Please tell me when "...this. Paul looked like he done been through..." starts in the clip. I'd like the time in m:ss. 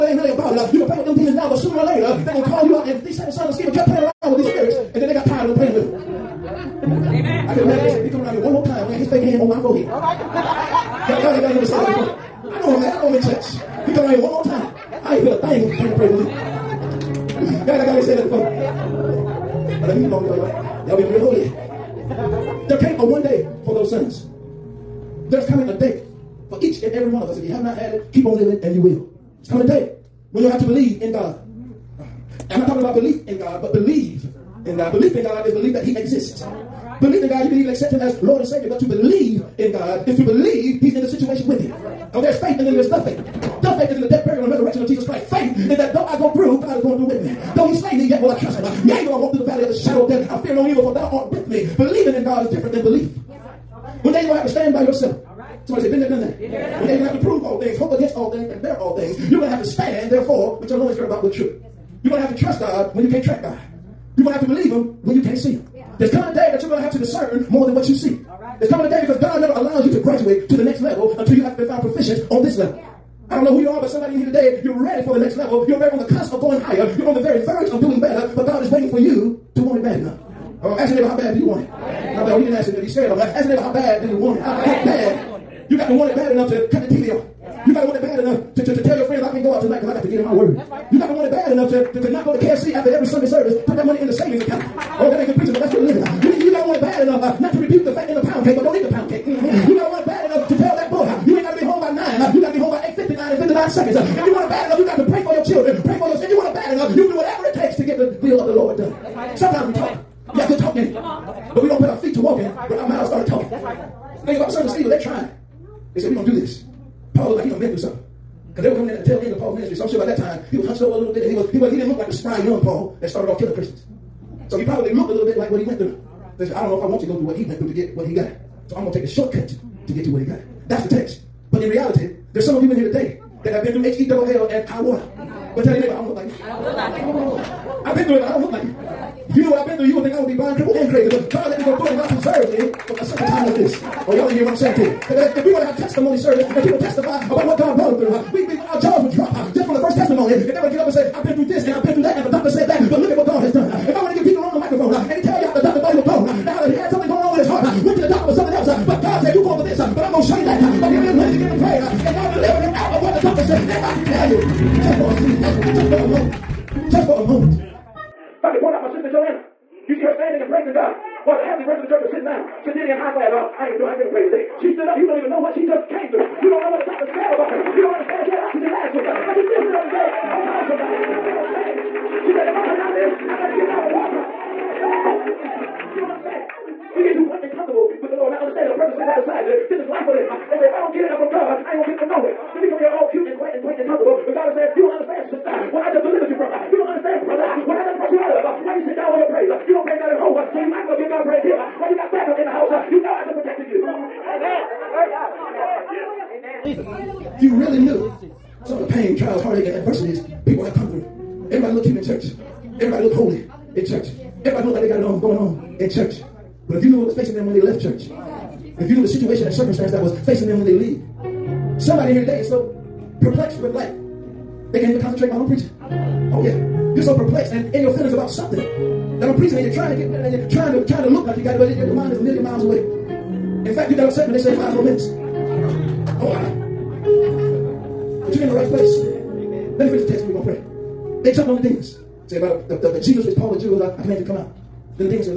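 1:56.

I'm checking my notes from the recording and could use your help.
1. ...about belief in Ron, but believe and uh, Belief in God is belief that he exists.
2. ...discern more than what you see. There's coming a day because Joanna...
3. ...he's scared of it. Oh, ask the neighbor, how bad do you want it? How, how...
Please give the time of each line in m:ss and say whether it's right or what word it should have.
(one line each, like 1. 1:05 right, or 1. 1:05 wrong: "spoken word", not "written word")
1. 0:32 wrong: "God", not "Ron"
2. 1:06 wrong: "God", not "Joanna"
3. 1:22 right.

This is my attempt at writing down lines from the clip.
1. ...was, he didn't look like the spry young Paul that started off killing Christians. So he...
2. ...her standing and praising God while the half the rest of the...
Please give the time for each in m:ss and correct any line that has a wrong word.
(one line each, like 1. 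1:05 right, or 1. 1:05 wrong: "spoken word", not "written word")
1. 2:01 right
2. 2:50 right.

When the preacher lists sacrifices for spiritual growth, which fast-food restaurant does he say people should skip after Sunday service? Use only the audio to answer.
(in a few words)
KFC.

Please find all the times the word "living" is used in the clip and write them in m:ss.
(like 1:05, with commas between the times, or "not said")
0:28, 1:35.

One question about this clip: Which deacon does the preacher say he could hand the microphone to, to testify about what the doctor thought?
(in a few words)
Deacon Ron.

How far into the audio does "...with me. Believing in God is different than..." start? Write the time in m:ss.
0:51.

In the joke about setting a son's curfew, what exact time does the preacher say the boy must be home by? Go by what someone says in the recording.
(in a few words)
8:59:59.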